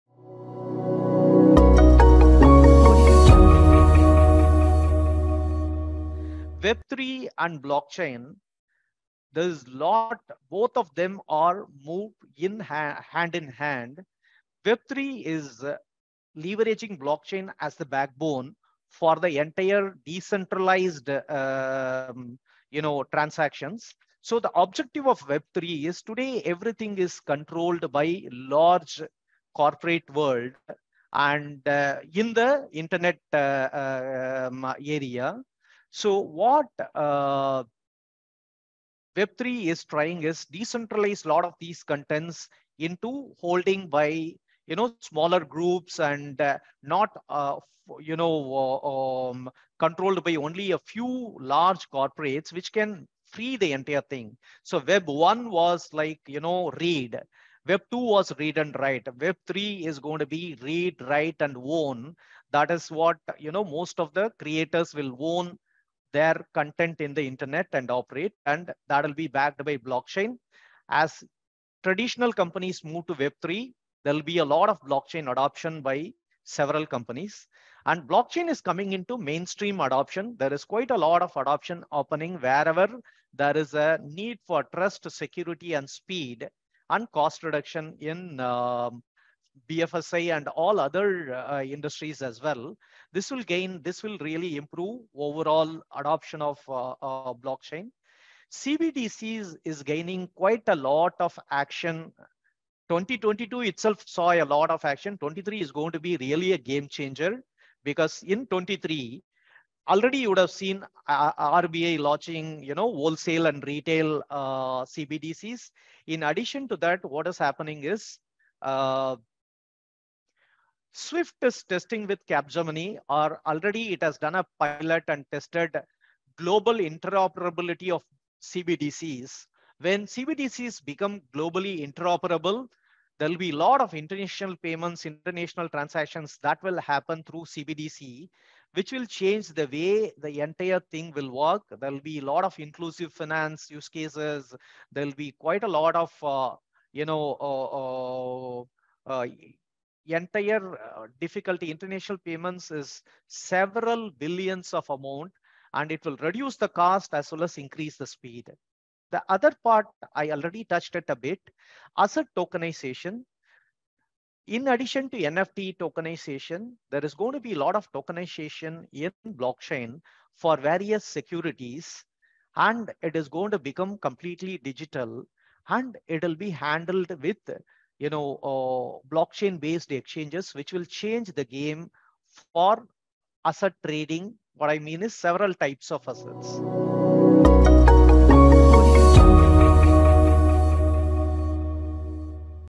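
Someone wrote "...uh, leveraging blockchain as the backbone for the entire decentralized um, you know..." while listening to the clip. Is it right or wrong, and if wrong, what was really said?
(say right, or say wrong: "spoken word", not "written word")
right.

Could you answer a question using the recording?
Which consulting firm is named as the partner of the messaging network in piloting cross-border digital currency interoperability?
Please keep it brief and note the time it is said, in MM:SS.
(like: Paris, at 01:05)
Capgemini, at 02:02.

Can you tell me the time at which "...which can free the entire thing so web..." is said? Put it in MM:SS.
00:52.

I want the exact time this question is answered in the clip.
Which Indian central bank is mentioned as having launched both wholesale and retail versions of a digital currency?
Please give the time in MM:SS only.
01:51.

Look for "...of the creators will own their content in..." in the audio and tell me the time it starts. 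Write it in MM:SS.
01:03.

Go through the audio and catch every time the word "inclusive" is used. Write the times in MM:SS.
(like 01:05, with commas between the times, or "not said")
02:22.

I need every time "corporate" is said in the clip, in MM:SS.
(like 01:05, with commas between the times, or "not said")
00:29, 00:51.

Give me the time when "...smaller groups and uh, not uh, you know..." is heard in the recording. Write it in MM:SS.
00:45.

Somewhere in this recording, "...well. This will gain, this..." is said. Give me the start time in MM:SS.
01:32.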